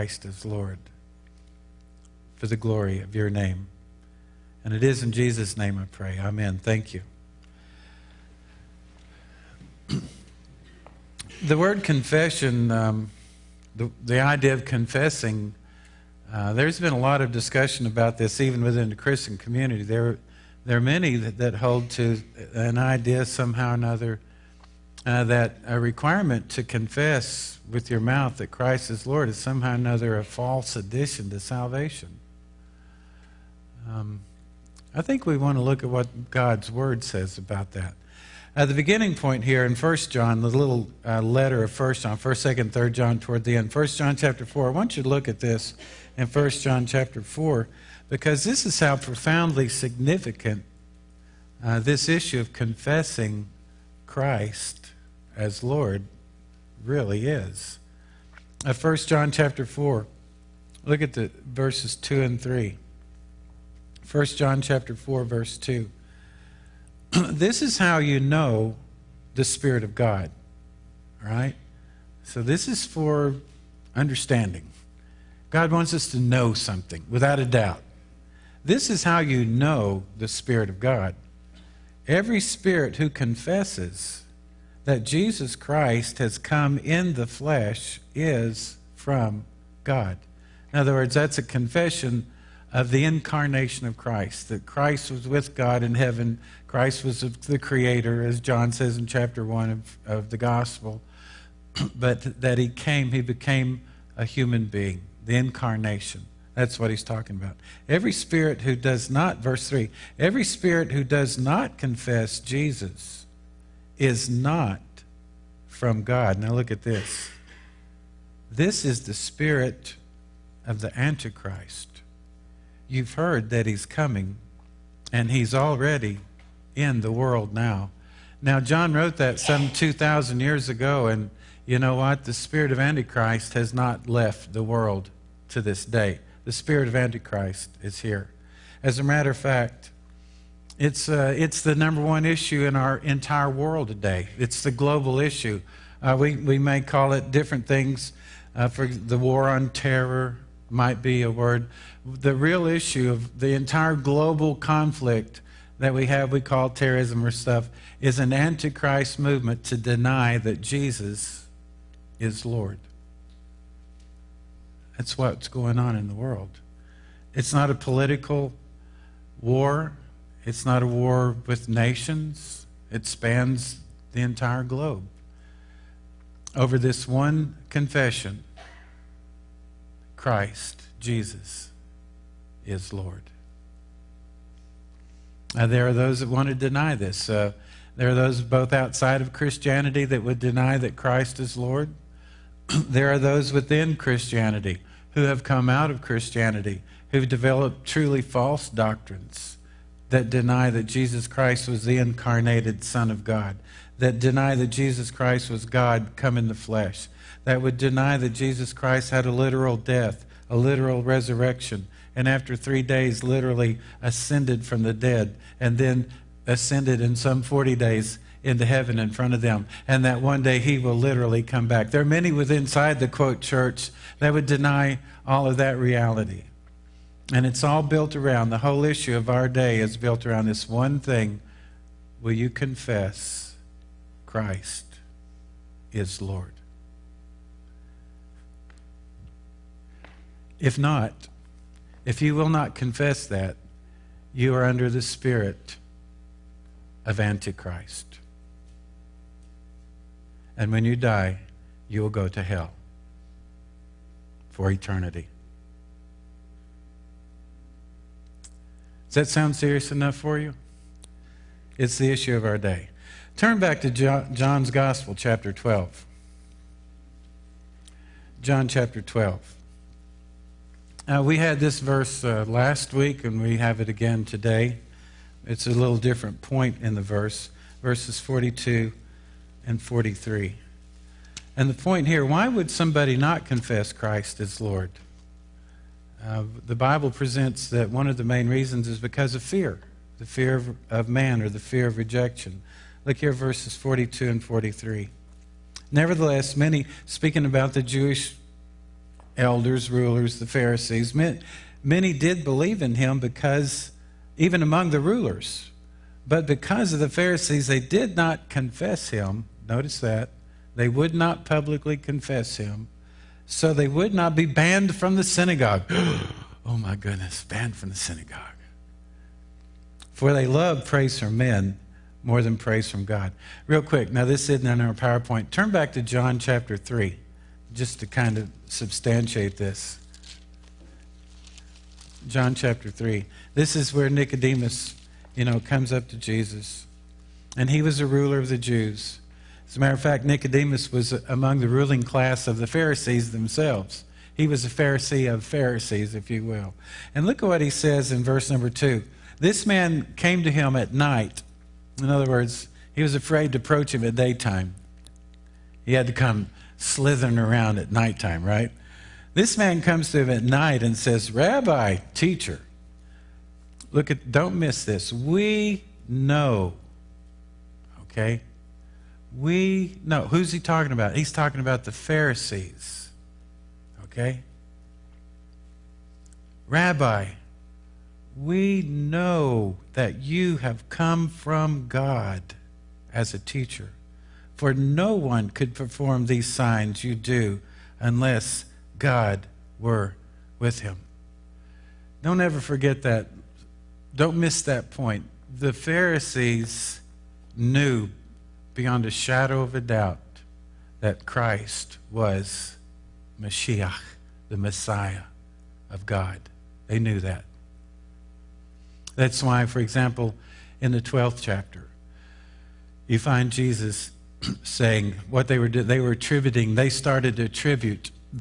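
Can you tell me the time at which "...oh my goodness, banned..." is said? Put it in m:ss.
5:16.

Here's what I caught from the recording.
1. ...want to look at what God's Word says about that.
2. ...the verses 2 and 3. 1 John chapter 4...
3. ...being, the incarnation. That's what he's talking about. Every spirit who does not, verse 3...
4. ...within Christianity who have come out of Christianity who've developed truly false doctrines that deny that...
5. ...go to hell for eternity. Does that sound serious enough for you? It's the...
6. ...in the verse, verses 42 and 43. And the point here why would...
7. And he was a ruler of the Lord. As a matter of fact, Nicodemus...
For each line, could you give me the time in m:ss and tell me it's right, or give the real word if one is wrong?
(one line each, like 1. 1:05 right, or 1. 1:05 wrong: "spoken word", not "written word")
1. 0:35 right
2. 1:01 right
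3. 1:44 right
4. 3:13 right
5. 4:12 right
6. 4:36 right
7. 5:37 wrong: "Jews", not "Lord".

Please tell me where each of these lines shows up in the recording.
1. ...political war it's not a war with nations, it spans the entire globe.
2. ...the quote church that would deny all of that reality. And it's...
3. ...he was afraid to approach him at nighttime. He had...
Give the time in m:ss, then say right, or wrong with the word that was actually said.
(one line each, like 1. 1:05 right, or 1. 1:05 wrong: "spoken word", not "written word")
1. 2:47 right
2. 3:43 right
3. 5:52 wrong: "daytime", not "nighttime".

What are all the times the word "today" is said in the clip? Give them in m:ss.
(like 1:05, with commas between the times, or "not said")
2:23, 4:34.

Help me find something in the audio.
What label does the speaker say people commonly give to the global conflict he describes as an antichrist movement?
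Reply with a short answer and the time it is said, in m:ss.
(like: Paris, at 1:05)
The war on terror, at 2:28.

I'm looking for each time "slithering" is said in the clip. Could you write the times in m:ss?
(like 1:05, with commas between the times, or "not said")
5:56.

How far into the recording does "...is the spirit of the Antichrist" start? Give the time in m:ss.
1:58.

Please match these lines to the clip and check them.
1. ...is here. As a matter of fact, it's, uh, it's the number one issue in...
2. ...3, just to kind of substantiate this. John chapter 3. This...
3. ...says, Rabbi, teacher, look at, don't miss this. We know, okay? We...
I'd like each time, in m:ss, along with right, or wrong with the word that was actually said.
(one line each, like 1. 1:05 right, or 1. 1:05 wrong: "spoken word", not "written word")
1. 2:17 right
2. 5:26 right
3. 6:00 right.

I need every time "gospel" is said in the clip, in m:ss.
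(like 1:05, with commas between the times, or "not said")
1:40, 4:24.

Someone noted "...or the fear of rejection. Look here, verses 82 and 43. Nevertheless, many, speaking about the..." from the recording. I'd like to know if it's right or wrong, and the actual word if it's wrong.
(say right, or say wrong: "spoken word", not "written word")
wrong: "42", not "82".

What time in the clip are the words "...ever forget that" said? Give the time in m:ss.
6:32.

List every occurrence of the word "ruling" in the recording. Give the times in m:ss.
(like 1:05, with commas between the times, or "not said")
5:41.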